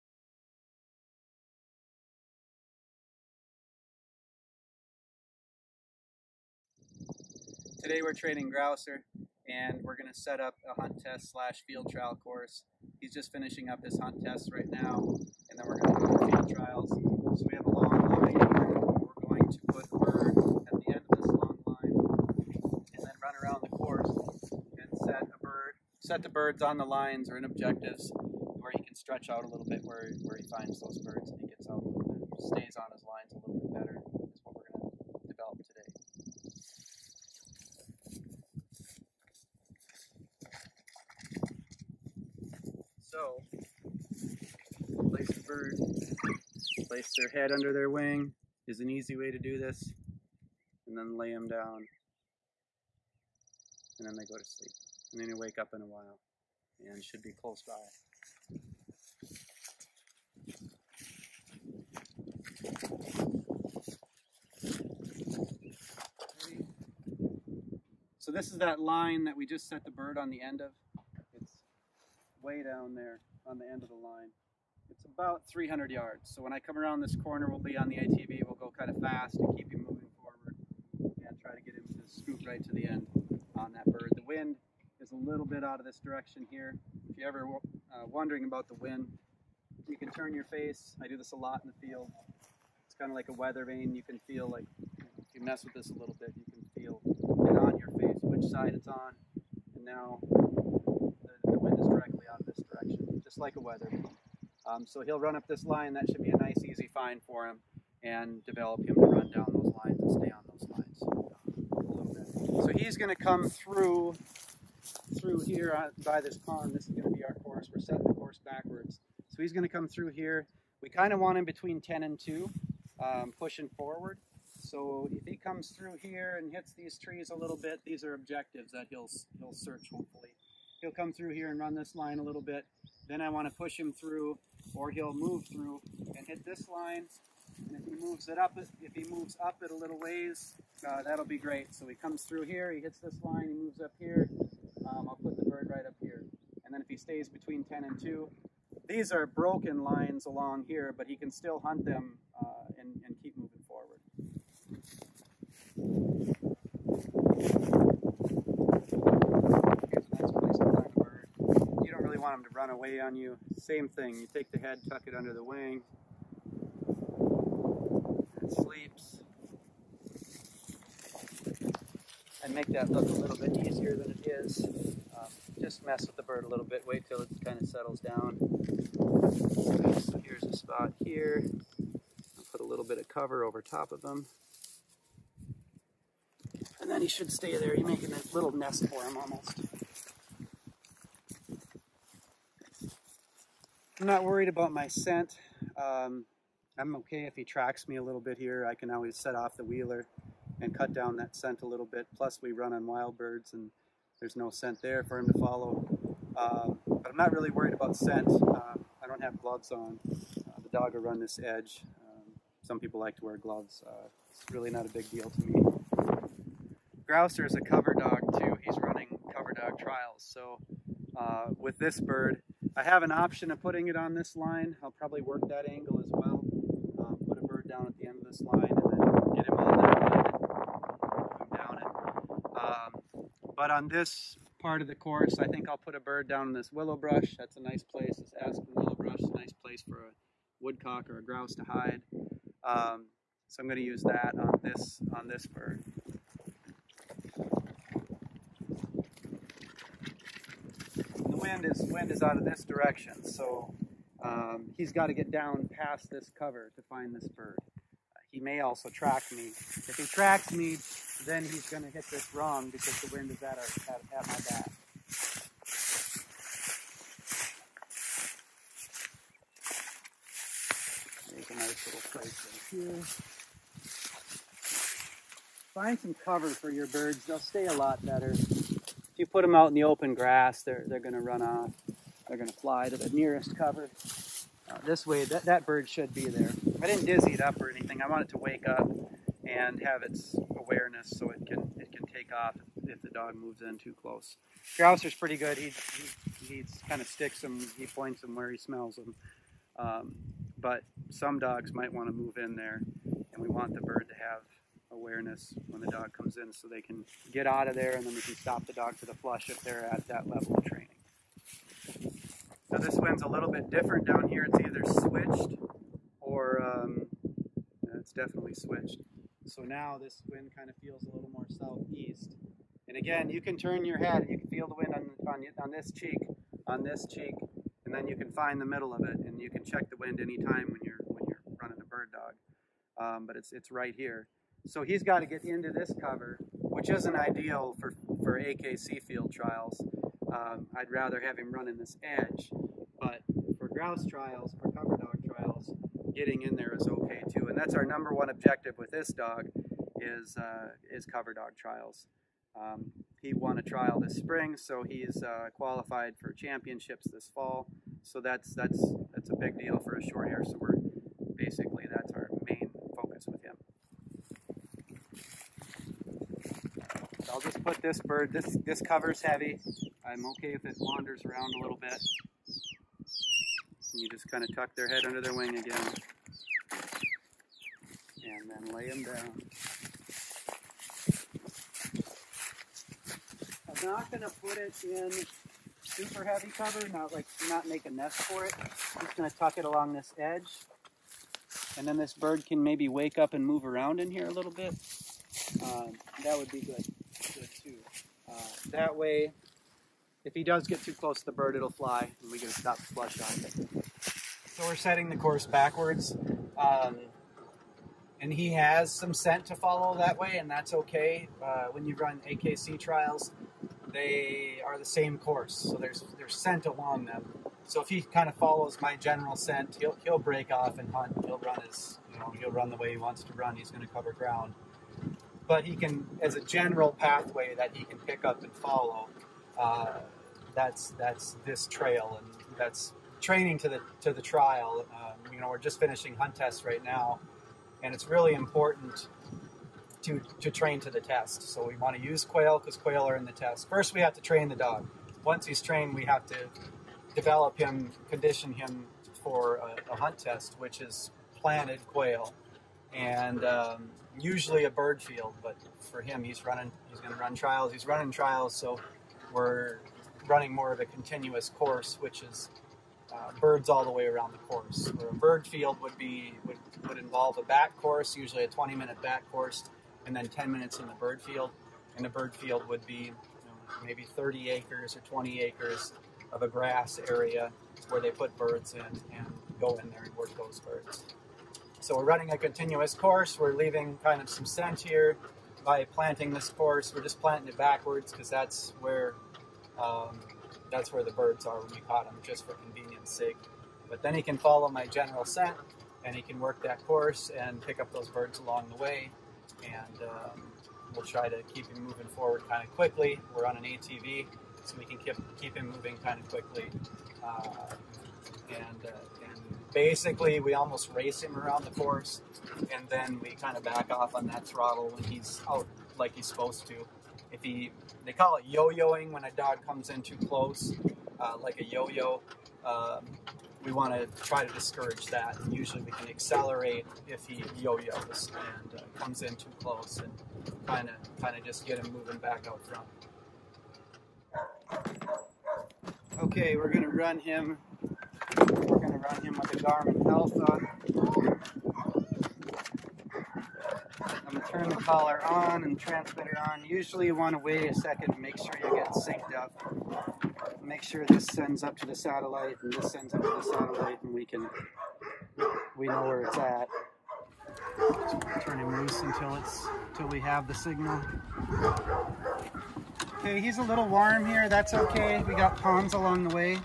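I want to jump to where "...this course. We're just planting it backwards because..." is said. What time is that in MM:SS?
08:06.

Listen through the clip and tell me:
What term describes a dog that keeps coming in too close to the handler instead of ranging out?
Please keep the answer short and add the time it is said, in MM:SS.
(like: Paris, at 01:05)
yo-yoing, at 08:38.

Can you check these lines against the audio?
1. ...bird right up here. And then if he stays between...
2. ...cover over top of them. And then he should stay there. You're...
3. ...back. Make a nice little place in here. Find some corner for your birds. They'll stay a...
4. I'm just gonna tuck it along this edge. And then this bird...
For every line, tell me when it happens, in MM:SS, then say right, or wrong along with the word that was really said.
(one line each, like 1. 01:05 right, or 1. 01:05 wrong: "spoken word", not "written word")
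1. 02:25 right
2. 03:03 right
3. 04:24 wrong: "cover", not "corner"
4. 06:28 right.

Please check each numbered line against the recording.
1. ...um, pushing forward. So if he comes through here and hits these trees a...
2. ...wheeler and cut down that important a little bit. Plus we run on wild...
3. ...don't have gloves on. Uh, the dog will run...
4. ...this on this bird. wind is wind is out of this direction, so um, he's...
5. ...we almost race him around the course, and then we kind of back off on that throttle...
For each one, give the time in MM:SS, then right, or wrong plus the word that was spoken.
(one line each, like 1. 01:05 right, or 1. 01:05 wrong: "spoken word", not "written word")
1. 02:03 right
2. 03:19 wrong: "scent", not "important"
3. 03:29 right
4. 04:04 right
5. 08:30 right.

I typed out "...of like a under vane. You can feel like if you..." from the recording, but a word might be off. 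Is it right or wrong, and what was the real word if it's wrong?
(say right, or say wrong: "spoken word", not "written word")
wrong: "weather", not "under".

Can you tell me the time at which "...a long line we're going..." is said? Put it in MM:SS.
00:17.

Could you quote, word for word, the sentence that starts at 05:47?
And that's our number one objective with this dog is, uh, is cover dog trials.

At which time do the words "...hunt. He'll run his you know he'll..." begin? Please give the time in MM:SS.
07:00.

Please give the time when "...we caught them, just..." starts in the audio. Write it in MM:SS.
08:11.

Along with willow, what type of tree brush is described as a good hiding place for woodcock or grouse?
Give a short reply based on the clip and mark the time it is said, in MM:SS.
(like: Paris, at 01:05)
aspen, at 03:58.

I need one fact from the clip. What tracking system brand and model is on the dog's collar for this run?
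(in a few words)
Garmin Alpha.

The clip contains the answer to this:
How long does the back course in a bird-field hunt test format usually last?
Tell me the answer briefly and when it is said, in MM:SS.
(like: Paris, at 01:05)
20 minutes, at 07:48.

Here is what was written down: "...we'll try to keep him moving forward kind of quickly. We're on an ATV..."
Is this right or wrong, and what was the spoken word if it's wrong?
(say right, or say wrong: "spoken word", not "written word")
right.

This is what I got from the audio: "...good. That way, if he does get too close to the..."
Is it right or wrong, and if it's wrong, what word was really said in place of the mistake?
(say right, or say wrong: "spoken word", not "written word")
right.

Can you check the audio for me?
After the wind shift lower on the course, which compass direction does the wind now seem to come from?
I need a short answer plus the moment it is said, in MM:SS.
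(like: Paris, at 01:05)
southeast, at 05:21.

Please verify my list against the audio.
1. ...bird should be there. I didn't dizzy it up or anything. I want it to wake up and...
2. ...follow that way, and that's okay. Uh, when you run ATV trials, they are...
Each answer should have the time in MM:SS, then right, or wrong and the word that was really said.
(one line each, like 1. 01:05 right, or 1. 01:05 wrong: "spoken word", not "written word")
1. 04:45 right
2. 06:49 wrong: "AKC", not "ATV".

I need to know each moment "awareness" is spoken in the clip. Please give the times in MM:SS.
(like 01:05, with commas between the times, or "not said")
04:50, 05:04.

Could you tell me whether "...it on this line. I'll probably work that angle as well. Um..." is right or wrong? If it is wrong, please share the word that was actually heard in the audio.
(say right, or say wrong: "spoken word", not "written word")
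right.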